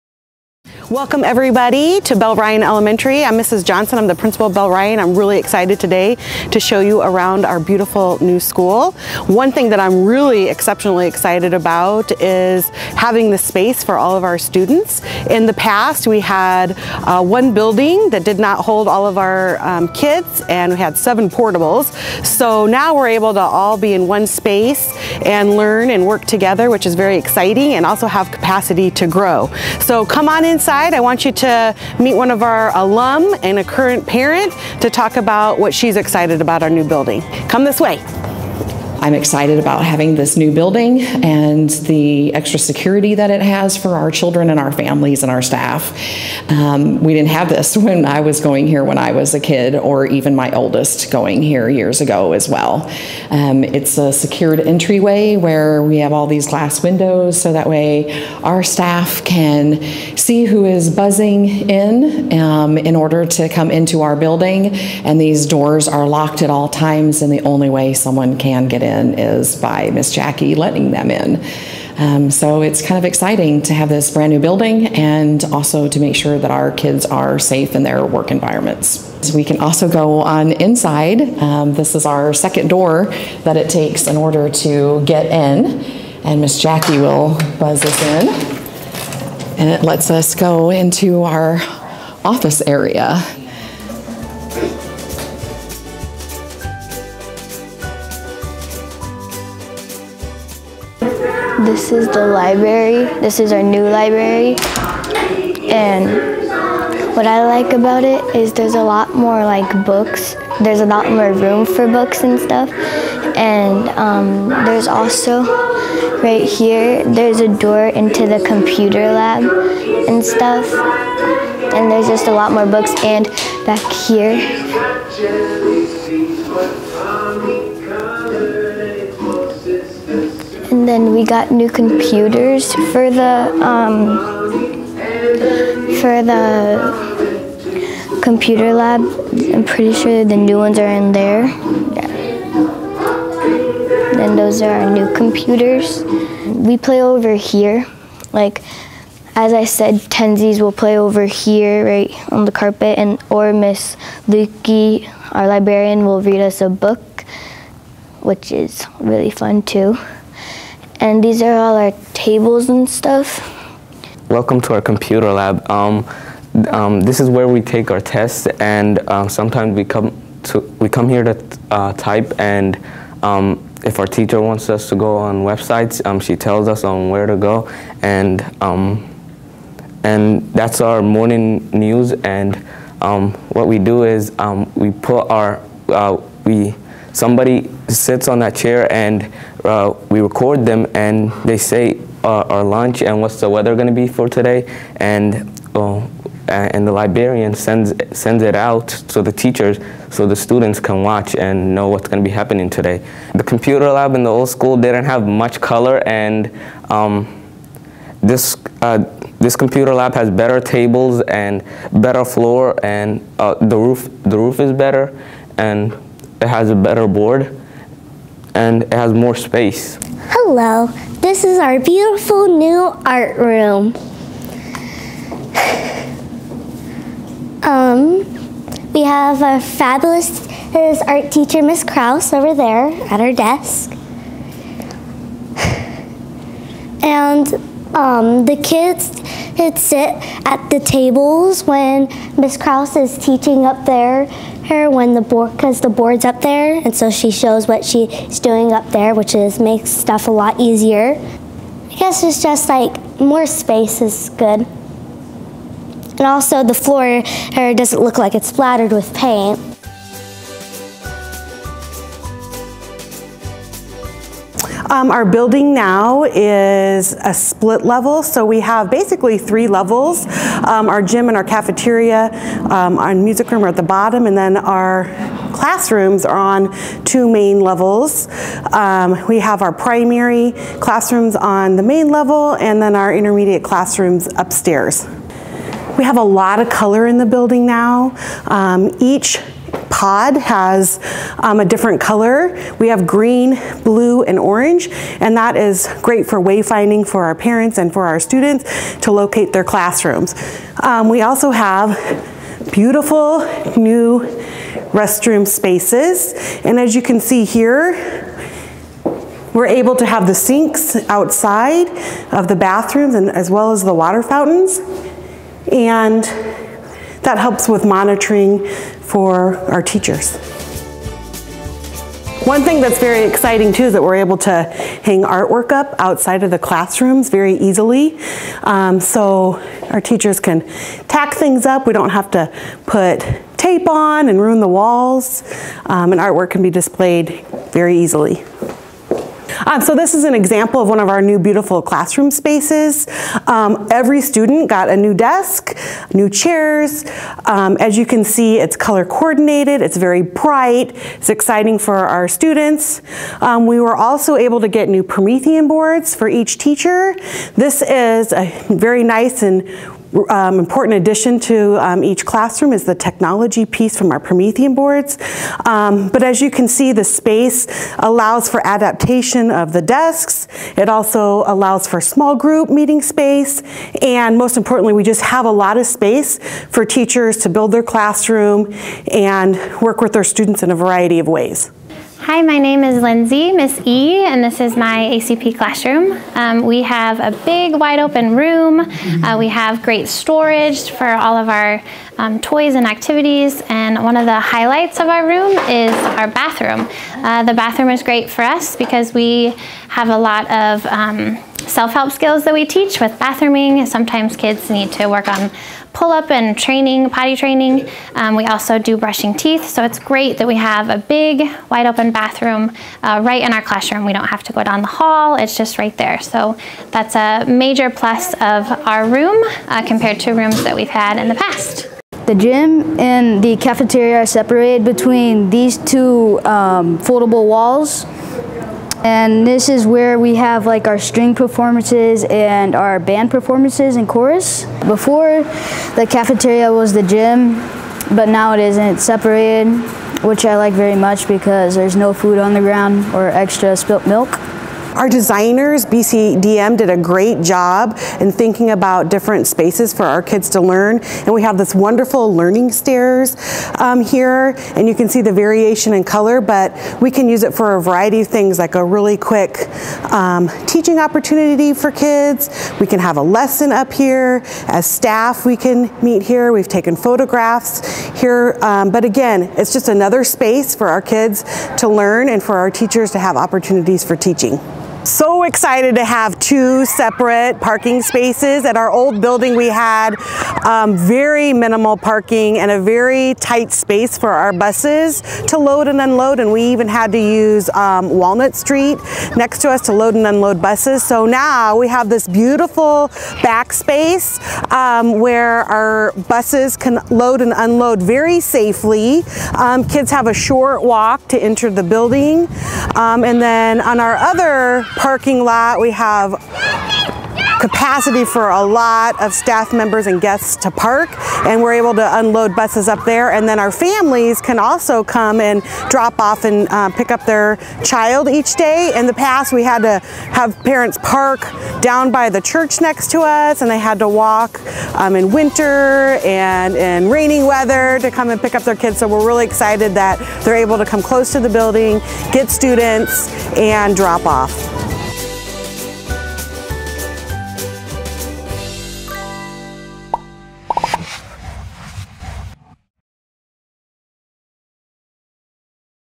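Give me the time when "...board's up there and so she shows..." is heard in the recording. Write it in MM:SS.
04:05.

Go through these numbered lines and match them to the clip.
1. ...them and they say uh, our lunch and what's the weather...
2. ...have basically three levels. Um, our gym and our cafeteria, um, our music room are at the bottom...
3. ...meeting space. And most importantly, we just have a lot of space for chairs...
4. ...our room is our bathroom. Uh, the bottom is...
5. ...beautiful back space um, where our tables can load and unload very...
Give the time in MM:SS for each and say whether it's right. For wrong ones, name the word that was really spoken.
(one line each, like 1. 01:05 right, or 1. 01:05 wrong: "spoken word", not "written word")
1. 03:10 right
2. 04:28 right
3. 06:12 wrong: "teachers", not "chairs"
4. 06:35 wrong: "bathroom", not "bottom"
5. 08:12 wrong: "buses", not "tables".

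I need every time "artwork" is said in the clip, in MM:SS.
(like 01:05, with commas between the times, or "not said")
05:25, 05:36.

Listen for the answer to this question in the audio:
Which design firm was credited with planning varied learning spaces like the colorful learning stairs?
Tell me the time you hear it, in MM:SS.
07:25.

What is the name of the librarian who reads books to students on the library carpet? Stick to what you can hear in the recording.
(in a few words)
Miss Lukey.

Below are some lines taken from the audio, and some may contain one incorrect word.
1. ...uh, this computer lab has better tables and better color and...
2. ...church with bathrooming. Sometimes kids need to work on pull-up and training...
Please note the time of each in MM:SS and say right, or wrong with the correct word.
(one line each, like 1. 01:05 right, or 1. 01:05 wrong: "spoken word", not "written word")
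1. 03:28 wrong: "floor", not "color"
2. 06:42 wrong: "teach", not "church".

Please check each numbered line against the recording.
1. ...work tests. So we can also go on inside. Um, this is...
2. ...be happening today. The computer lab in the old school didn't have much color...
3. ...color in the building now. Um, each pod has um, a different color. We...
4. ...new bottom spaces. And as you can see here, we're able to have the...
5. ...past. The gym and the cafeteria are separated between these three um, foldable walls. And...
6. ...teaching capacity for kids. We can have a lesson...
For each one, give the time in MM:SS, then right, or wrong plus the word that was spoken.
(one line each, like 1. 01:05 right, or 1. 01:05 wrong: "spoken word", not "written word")
1. 01:18 wrong: "environments", not "tests"
2. 03:22 right
3. 04:46 right
4. 05:03 wrong: "restroom", not "bottom"
5. 07:01 wrong: "two", not "three"
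6. 07:40 wrong: "opportunity", not "capacity".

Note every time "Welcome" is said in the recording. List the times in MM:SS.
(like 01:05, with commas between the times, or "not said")
00:00, 02:44.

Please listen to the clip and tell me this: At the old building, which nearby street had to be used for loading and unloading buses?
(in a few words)
Walnut Street.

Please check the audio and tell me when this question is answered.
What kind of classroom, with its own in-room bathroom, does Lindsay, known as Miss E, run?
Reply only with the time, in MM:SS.
06:25.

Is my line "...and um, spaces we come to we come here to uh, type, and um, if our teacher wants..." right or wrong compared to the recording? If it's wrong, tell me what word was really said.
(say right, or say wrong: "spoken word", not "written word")
wrong: "sometimes", not "spaces".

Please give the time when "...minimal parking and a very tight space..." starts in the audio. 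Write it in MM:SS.
08:01.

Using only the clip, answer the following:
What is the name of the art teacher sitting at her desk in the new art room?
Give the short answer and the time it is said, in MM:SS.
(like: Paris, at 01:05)
Miss Kraus, at 03:51.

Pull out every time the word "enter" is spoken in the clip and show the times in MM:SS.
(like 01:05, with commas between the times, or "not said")
08:21.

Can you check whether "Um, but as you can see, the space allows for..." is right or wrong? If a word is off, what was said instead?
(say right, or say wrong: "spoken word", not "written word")
right.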